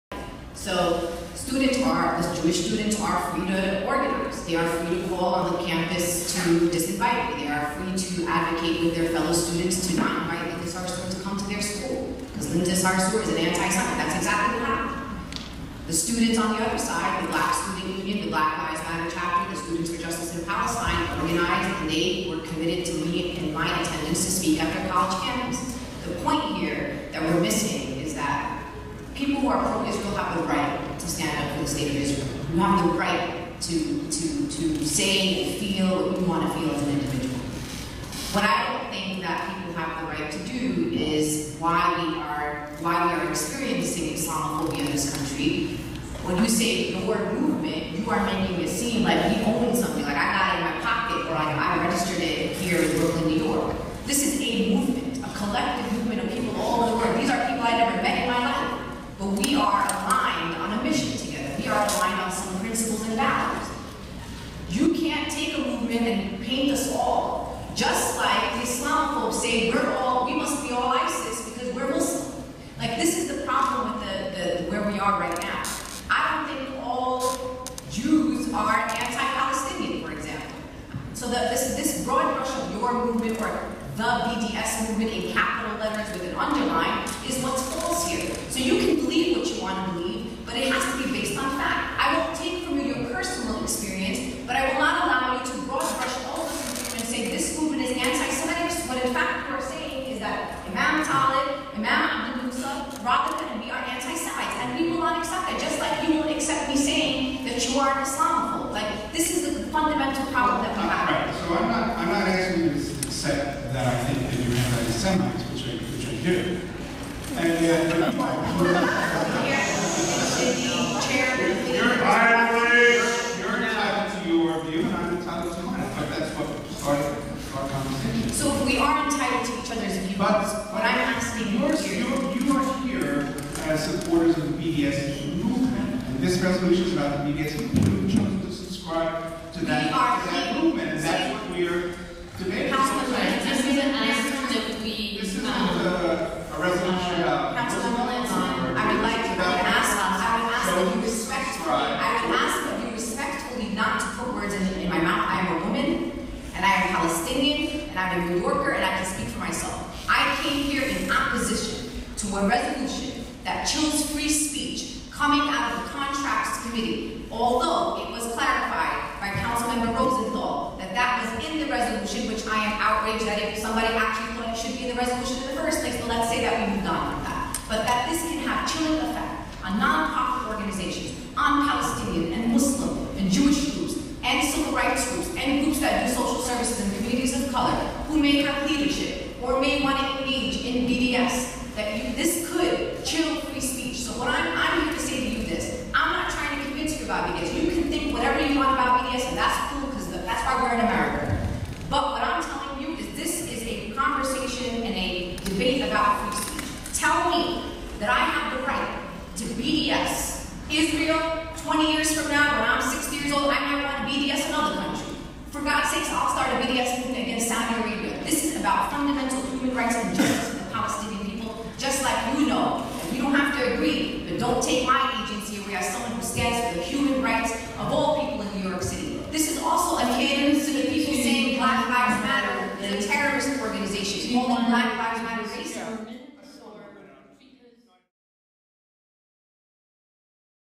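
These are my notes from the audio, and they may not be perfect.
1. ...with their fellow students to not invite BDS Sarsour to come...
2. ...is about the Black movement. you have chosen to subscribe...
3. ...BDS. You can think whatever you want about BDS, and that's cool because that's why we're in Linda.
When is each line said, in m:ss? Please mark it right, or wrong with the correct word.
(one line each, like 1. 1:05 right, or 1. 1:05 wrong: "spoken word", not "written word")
1. 0:08 wrong: "Linda", not "BDS"
2. 2:16 wrong: "BDS", not "Black"
3. 3:17 wrong: "America", not "Linda".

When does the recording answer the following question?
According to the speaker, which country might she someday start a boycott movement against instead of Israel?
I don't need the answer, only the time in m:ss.
3:37.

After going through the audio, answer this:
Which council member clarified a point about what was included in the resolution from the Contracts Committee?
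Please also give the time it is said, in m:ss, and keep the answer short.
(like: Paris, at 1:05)
Rosenthal, at 2:49.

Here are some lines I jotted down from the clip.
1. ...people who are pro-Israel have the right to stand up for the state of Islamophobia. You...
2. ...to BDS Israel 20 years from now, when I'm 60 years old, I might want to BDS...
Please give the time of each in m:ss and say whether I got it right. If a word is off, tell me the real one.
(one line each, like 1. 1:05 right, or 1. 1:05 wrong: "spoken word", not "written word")
1. 0:29 wrong: "Israel", not "Islamophobia"
2. 3:29 right.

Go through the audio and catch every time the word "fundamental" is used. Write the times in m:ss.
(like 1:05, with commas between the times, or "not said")
1:49, 3:38.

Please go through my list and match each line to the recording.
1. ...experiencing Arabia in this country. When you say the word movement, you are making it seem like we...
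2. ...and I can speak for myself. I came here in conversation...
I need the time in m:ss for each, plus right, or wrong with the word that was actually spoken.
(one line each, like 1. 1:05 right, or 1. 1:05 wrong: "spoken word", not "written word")
1. 0:43 wrong: "Islamophobia", not "Arabia"
2. 2:38 wrong: "opposition", not "conversation".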